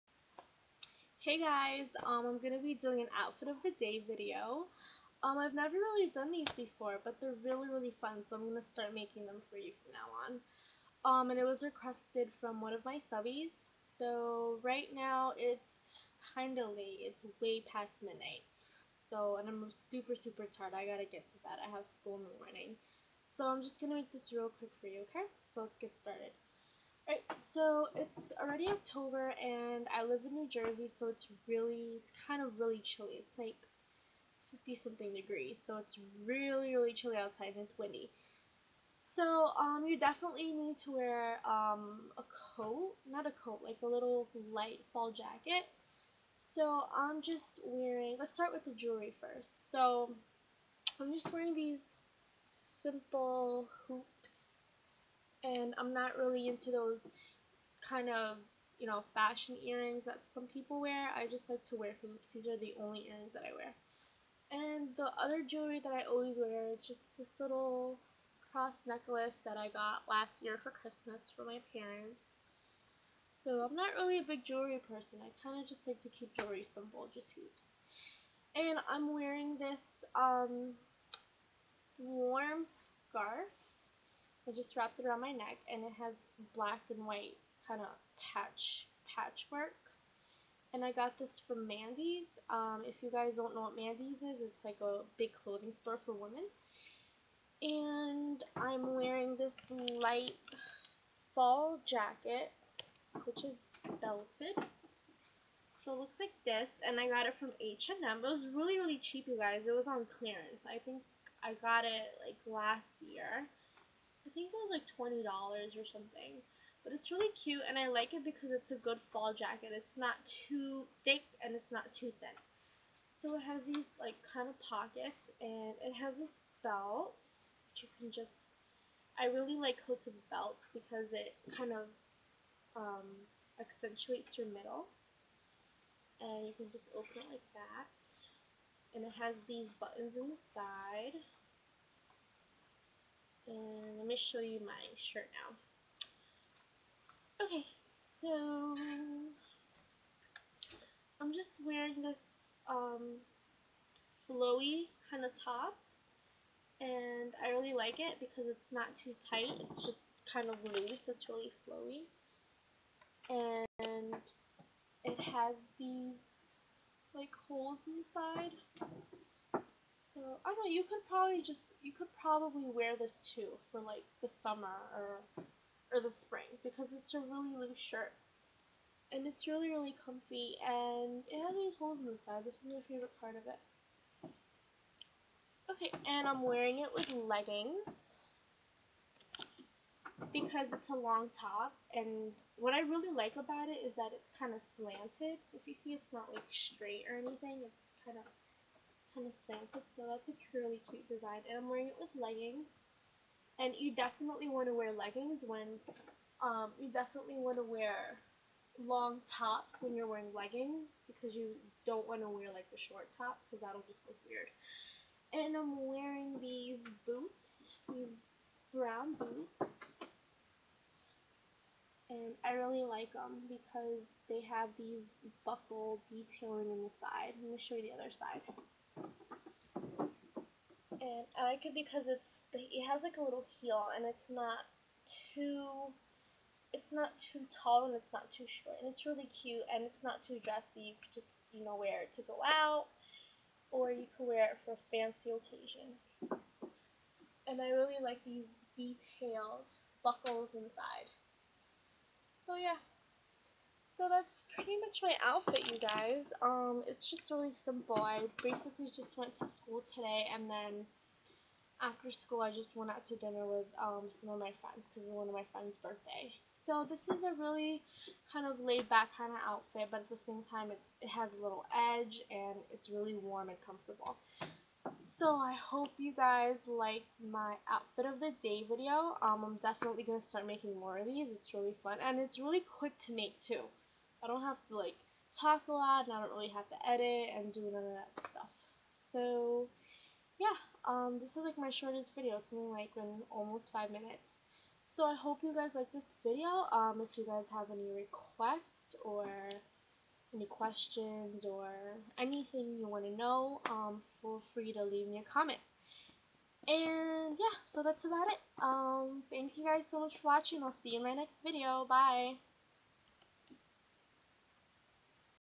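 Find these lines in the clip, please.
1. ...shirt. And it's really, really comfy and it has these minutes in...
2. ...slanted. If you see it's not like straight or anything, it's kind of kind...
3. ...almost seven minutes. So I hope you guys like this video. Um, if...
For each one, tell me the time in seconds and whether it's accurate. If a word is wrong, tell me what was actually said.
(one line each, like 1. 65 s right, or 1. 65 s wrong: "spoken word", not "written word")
1. 177 s wrong: "holes", not "minutes"
2. 194 s right
3. 293 s wrong: "five", not "seven".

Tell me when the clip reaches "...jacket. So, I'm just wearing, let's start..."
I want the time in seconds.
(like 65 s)
45 s.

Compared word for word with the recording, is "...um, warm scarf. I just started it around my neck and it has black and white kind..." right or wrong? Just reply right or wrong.
wrong.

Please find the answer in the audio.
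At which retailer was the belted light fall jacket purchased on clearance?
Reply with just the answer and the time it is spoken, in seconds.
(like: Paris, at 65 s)
H&M, at 107 s.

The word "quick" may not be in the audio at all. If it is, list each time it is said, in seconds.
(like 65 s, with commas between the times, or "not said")
24 s, 282 s.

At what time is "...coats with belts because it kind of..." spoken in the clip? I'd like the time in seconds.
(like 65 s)
129 s.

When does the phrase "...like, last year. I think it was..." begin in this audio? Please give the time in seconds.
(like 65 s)
112 s.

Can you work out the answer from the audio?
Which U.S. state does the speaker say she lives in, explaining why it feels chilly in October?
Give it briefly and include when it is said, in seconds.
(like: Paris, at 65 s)
New Jersey, at 30 s.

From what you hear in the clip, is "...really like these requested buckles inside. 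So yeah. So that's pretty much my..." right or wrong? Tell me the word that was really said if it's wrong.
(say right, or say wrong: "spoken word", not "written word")
wrong: "detailed", not "requested".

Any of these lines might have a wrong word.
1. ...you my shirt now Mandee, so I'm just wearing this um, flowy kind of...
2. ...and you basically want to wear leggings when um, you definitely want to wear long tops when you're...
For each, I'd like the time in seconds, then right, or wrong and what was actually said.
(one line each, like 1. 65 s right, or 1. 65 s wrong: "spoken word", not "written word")
1. 144 s wrong: "Okay", not "Mandee"
2. 203 s wrong: "definitely", not "basically".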